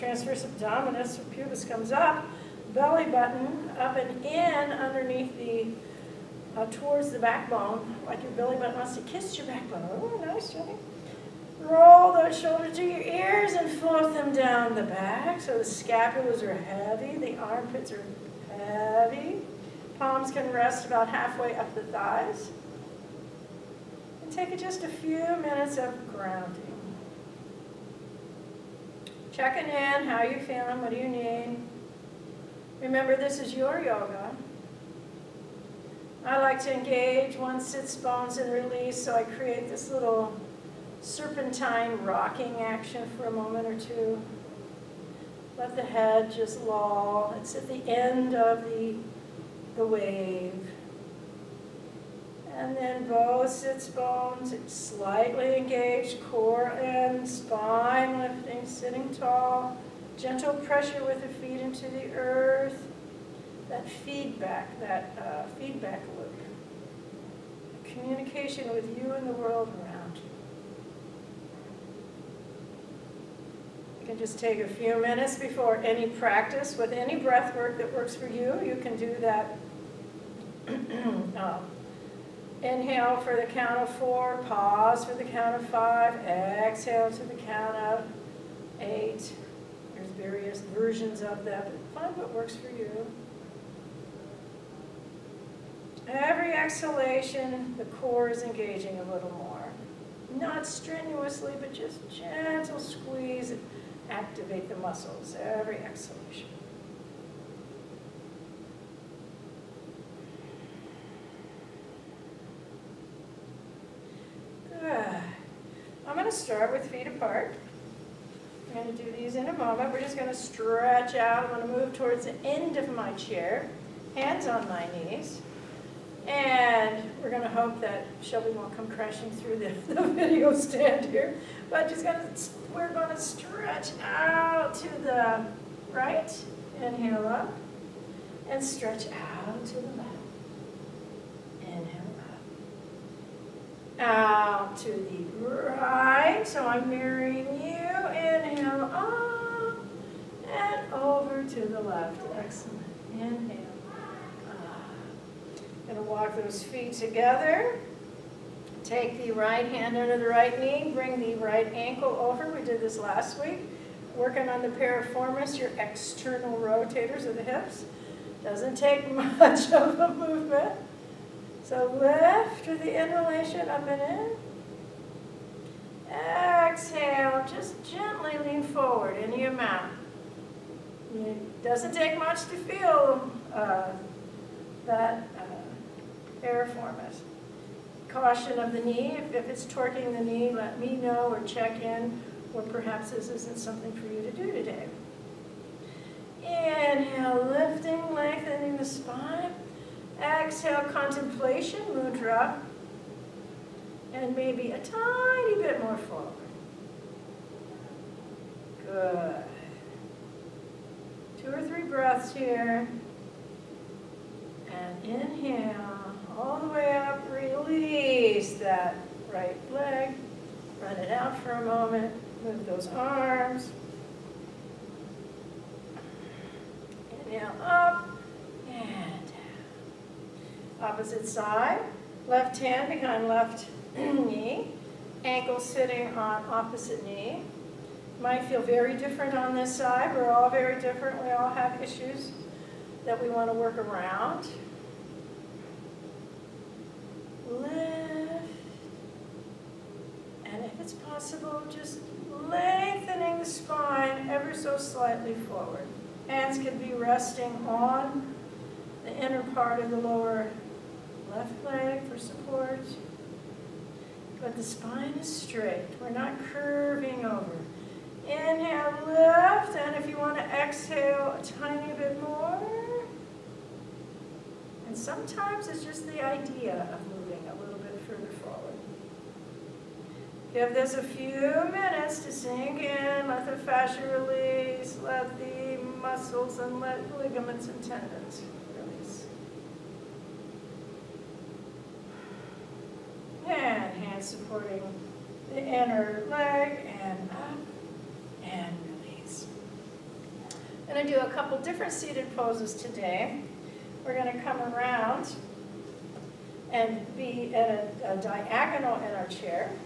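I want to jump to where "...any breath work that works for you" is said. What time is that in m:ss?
1:16.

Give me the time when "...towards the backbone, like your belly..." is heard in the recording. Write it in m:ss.
0:06.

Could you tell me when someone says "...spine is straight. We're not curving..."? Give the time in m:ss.
4:24.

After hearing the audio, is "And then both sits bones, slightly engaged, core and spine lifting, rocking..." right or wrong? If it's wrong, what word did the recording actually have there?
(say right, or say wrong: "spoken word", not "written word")
wrong: "sitting", not "rocking".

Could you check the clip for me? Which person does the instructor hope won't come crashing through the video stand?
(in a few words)
Shelby.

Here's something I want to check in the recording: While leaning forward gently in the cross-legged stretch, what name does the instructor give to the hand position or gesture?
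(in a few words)
contemplation mudra.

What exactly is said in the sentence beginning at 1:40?
Not strenuously, but just gentle squeeze, activate the muscles, every exhalation.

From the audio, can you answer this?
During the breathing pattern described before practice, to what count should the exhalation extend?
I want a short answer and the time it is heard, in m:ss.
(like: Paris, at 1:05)
8, at 1:28.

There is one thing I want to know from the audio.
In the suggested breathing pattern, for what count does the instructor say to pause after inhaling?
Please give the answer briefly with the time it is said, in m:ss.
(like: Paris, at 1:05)
5, at 1:25.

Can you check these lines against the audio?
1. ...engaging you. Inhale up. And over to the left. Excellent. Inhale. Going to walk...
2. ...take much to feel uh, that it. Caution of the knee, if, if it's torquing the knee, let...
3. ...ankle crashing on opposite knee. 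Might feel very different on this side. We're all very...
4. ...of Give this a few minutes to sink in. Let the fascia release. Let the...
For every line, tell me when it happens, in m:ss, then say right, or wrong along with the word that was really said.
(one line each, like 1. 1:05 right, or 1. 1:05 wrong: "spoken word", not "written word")
1. 2:26 wrong: "mirroring", not "engaging"
2. 3:01 right
3. 3:55 wrong: "sitting", not "crashing"
4. 4:36 right.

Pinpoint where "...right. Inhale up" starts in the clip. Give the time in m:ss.
2:15.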